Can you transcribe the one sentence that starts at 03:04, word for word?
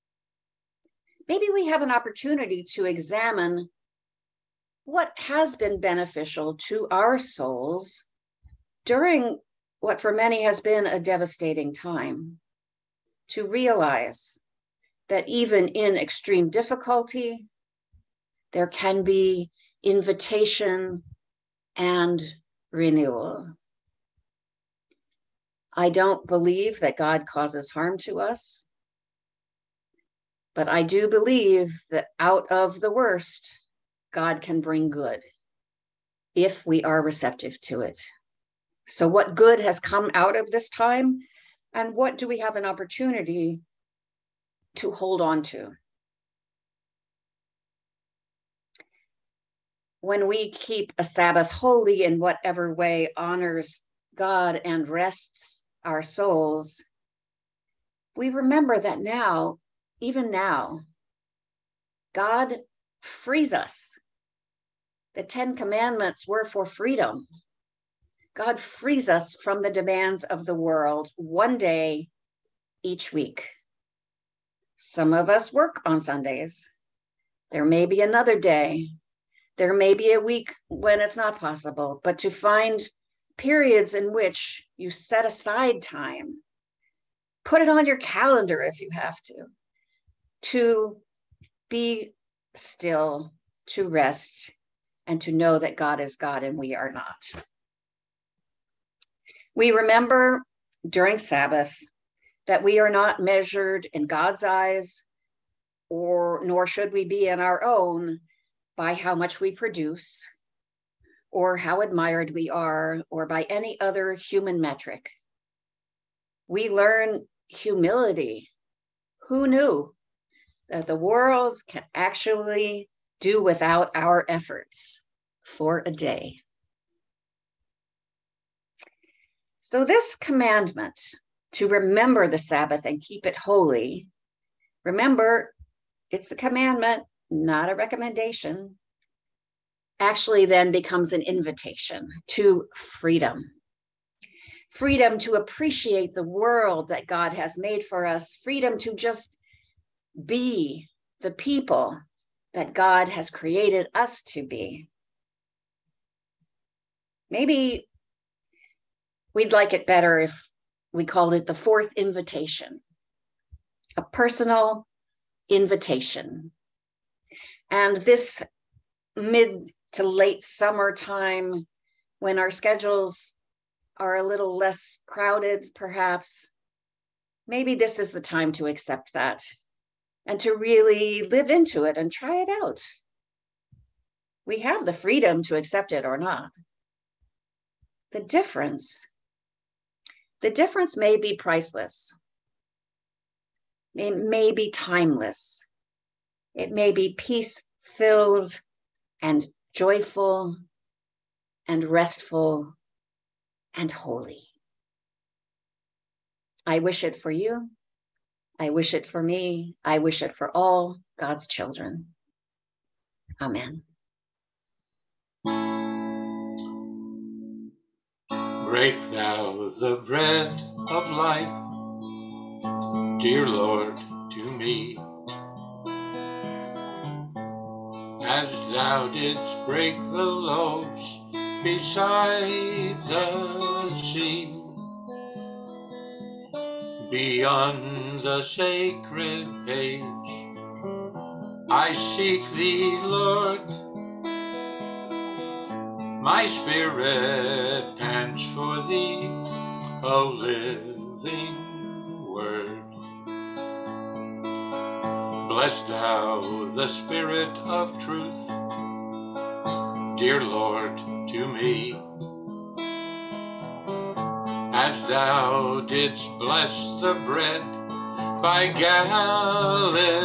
We have the freedom to accept it or not.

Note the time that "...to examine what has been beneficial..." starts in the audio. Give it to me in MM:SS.
00:02.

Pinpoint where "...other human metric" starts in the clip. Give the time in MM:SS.
01:53.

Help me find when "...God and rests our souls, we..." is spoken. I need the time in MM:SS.
00:54.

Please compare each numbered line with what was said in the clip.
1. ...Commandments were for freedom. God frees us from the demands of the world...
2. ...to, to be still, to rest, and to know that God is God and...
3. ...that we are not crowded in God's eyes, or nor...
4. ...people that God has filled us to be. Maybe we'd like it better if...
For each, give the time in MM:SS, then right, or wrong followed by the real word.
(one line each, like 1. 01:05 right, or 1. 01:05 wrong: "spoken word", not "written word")
1. 01:05 right
2. 01:29 right
3. 01:42 wrong: "measured", not "crowded"
4. 02:31 wrong: "created", not "filled".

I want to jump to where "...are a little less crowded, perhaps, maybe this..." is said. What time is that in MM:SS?
02:53.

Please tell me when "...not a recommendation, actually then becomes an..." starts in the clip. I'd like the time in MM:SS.
02:17.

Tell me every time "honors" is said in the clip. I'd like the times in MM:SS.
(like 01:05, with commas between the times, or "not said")
00:53.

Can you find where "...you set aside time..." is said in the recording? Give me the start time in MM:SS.
01:24.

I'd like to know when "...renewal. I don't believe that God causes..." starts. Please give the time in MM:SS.
00:22.